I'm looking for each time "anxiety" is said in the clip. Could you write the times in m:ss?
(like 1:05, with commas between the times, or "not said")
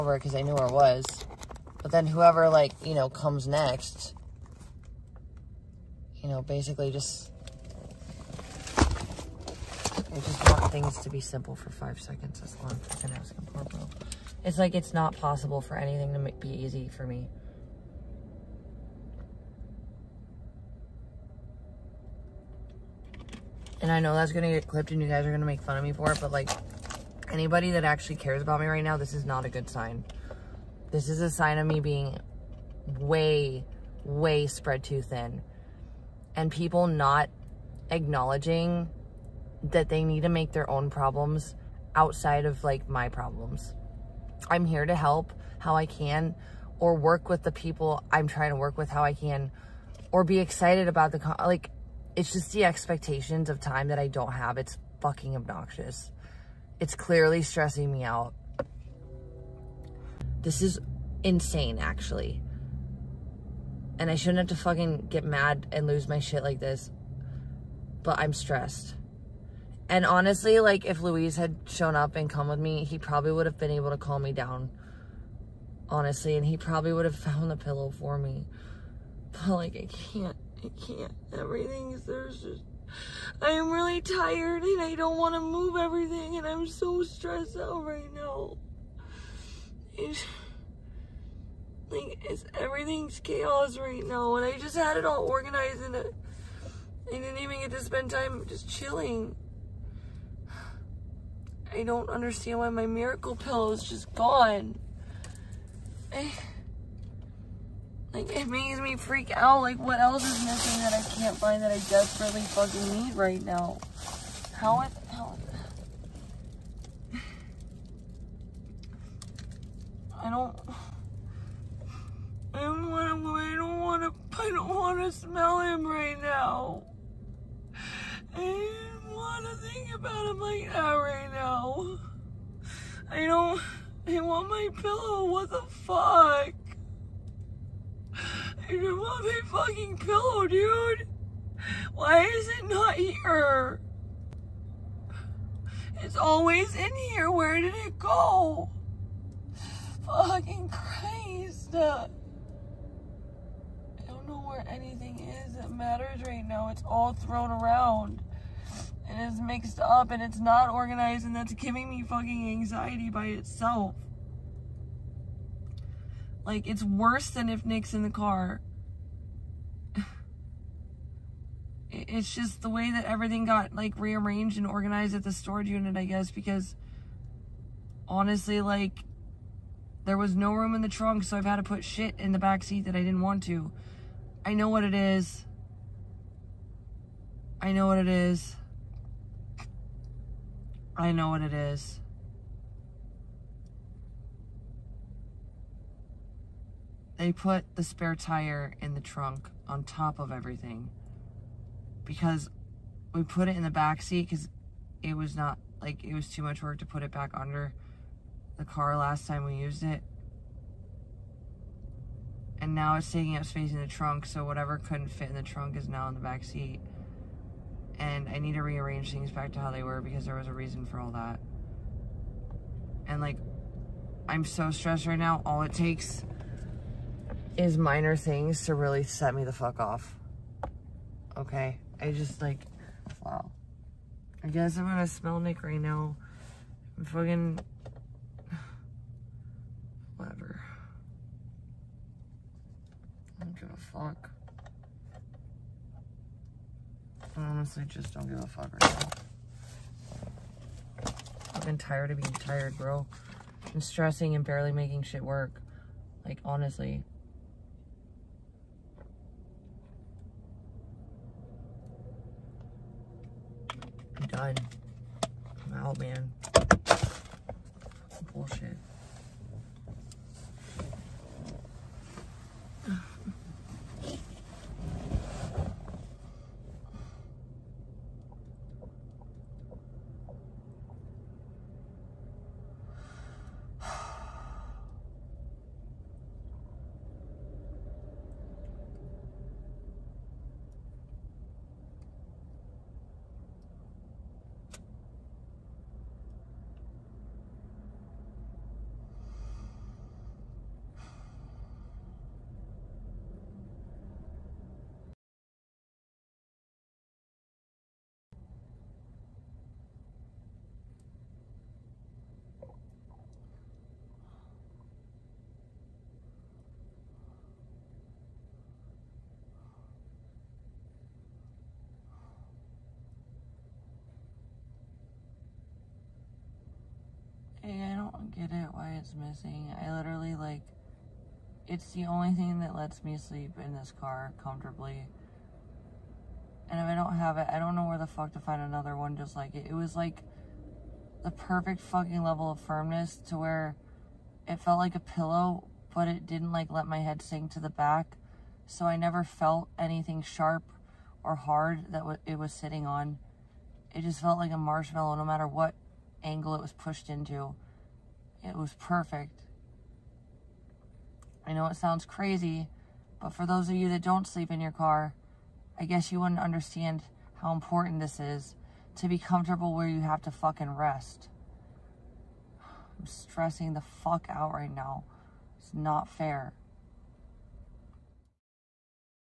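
2:42.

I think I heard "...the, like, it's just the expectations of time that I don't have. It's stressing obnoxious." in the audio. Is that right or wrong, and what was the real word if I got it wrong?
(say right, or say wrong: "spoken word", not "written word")
wrong: "fucking", not "stressing".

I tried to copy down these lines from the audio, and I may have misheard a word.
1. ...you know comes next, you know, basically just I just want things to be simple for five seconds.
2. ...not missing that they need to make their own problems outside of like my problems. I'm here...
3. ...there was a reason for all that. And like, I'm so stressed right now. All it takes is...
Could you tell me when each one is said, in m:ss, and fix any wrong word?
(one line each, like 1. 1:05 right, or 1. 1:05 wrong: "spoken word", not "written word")
1. 0:02 right
2. 0:36 wrong: "acknowledging", not "missing"
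3. 3:40 right.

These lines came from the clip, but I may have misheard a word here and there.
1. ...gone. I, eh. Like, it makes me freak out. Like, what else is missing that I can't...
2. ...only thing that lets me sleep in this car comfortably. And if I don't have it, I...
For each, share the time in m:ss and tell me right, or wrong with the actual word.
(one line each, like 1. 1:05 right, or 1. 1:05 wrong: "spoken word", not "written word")
1. 1:44 right
2. 5:32 right.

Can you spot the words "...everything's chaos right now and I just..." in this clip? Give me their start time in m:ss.
1:32.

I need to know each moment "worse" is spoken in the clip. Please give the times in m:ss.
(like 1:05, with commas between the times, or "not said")
2:46.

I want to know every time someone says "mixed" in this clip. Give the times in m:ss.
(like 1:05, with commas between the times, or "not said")
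2:39.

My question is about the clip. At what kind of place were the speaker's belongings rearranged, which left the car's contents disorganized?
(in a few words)
Storage unit.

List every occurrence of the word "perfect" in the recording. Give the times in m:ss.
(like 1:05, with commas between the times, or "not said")
5:41, 5:58.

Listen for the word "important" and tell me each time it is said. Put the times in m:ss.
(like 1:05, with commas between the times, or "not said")
6:07.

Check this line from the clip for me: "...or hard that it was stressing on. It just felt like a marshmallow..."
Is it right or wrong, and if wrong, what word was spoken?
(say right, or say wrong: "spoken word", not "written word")
wrong: "sitting", not "stressing".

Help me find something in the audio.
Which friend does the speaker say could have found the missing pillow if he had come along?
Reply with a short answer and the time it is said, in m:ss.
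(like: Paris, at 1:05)
Louise, at 1:11.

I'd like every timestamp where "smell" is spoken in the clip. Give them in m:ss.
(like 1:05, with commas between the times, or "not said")
2:05, 3:55.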